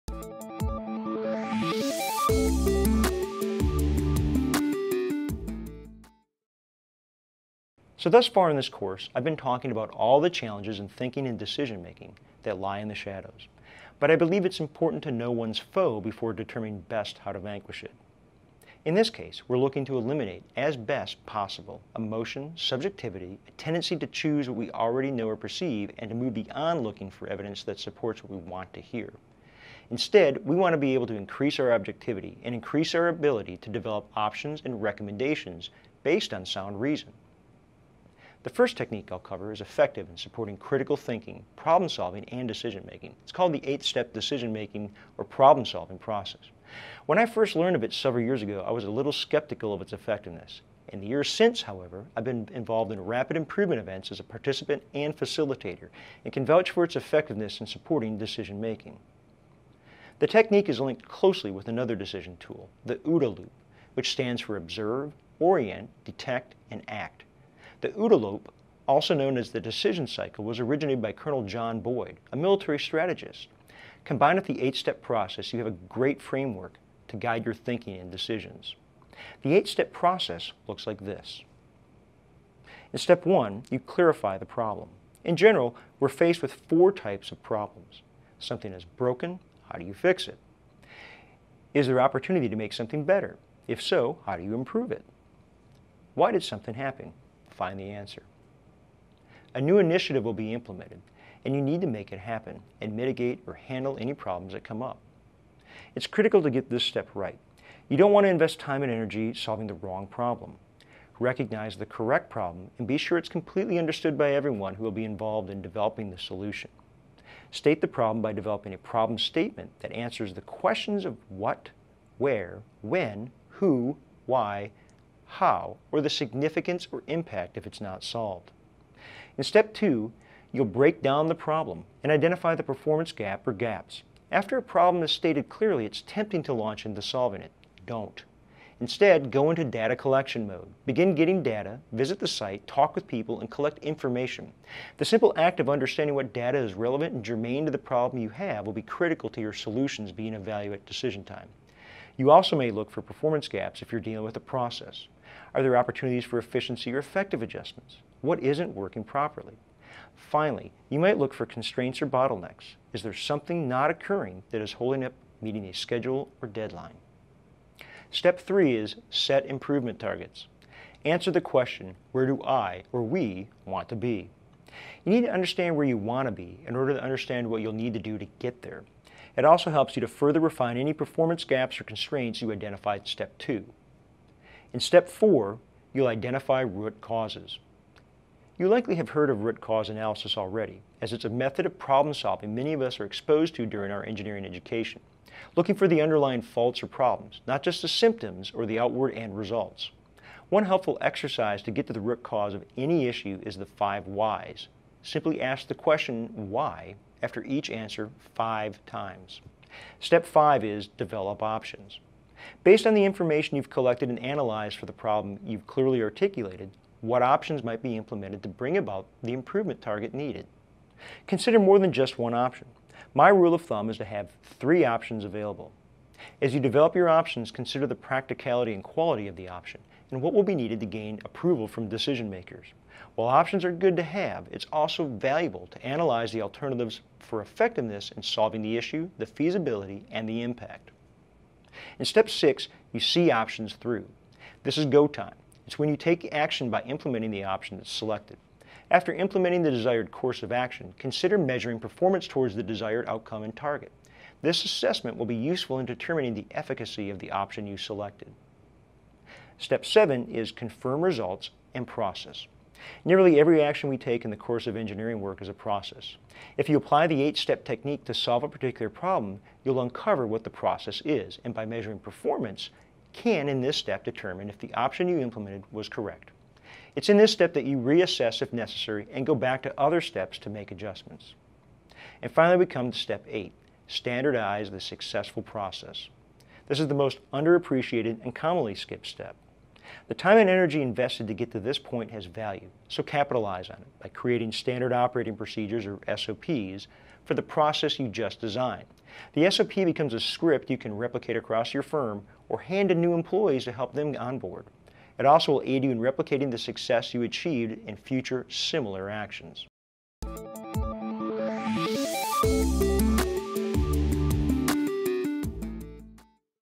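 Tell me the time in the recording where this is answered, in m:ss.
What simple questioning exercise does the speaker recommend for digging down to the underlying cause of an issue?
3:23.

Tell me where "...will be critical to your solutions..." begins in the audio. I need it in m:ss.
2:28.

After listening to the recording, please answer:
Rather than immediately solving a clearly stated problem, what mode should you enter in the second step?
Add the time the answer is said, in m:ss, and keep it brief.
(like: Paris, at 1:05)
Data collection mode, at 2:19.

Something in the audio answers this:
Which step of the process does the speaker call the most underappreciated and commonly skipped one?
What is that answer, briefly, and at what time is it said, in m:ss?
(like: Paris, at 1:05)
Step 8, at 4:42.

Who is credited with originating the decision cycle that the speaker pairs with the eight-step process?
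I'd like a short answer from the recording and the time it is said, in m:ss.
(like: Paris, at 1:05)
Colonel John Boyd, at 1:11.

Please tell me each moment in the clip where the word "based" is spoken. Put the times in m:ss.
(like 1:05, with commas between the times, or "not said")
0:36, 3:32.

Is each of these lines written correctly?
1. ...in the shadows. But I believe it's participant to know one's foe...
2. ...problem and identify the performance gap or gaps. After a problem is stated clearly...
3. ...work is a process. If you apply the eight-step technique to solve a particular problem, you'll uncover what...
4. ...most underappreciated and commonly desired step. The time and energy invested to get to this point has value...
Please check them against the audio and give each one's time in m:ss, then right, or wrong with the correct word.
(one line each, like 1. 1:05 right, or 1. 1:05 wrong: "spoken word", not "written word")
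1. 0:12 wrong: "important", not "participant"
2. 2:11 right
3. 4:25 right
4. 4:46 wrong: "skipped", not "desired".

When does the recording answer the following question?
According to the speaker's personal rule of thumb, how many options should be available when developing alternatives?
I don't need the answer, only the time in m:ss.
3:44.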